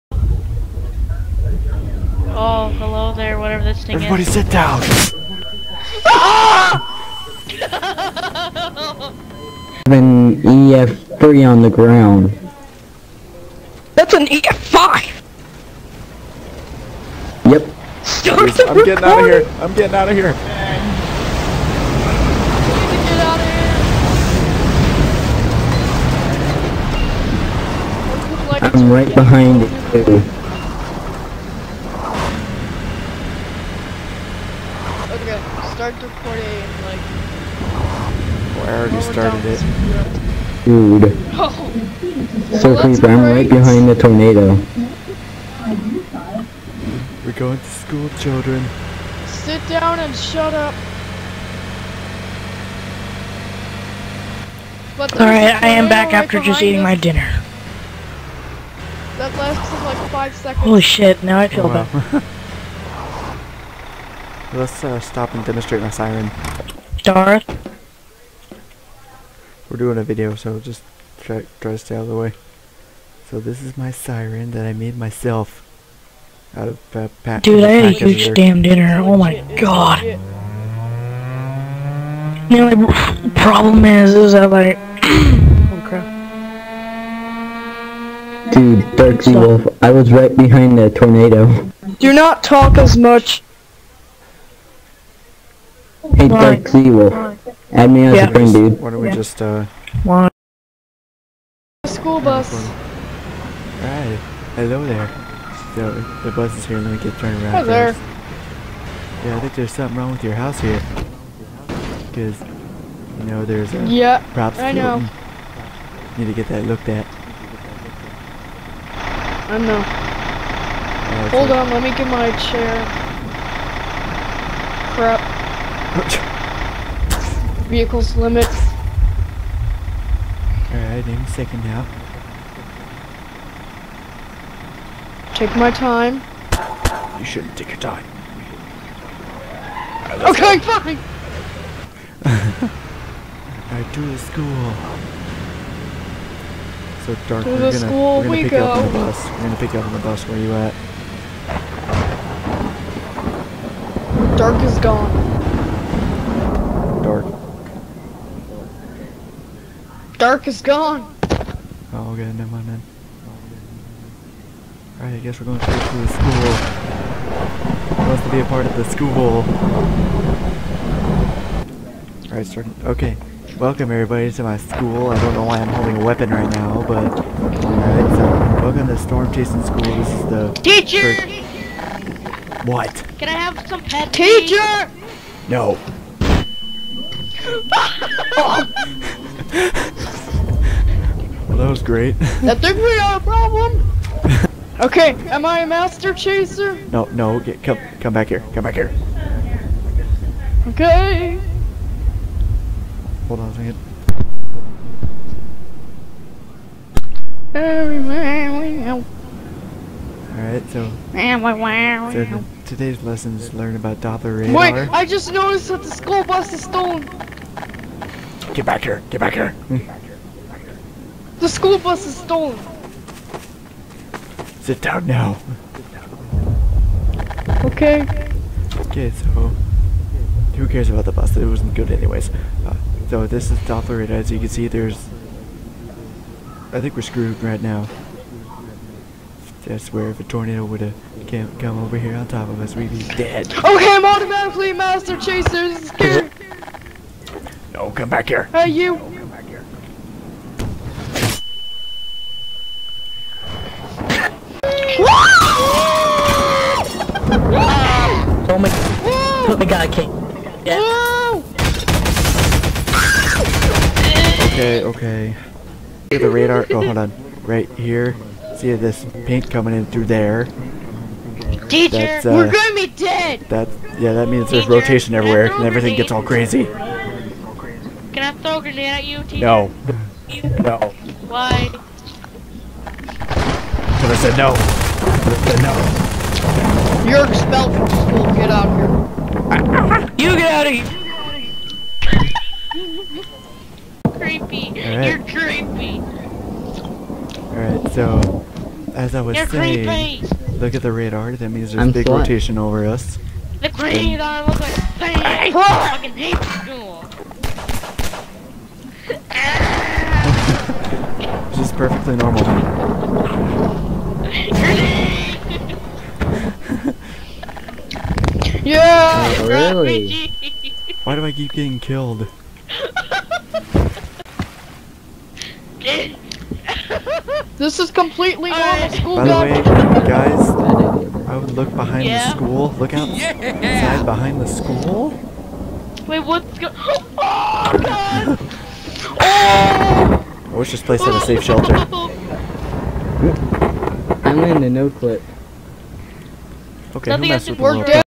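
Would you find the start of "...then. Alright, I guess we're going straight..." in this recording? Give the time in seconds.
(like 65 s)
162 s.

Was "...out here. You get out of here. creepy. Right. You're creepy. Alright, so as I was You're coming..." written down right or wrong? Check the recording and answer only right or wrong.
wrong.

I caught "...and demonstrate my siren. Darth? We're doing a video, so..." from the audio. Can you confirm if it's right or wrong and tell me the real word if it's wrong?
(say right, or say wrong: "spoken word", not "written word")
right.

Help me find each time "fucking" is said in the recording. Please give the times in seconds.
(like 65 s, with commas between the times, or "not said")
305 s.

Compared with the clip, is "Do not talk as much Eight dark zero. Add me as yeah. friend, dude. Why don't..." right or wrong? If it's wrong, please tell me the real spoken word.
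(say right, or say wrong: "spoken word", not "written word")
right.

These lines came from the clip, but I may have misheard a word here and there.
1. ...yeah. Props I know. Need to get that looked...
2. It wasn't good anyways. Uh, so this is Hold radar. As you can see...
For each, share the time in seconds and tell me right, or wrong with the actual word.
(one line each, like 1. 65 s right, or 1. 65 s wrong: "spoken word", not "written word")
1. 113 s right
2. 231 s wrong: "Doppler", not "Hold".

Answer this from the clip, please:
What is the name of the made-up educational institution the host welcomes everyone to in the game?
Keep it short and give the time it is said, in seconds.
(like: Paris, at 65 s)
Storm Chasing School, at 178 s.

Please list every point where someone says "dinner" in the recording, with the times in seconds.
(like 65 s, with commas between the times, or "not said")
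56 s, 78 s.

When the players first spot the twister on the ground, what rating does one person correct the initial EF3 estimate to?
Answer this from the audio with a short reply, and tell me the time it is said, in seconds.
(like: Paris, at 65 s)
EF5, at 14 s.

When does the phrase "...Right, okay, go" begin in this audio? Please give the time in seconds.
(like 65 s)
140 s.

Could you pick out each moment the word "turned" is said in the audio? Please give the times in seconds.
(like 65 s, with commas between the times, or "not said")
107 s.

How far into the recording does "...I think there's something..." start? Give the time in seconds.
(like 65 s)
109 s.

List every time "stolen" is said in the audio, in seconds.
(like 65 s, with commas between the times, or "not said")
216 s, 222 s.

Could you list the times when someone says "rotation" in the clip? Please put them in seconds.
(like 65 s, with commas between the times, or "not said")
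274 s, 302 s.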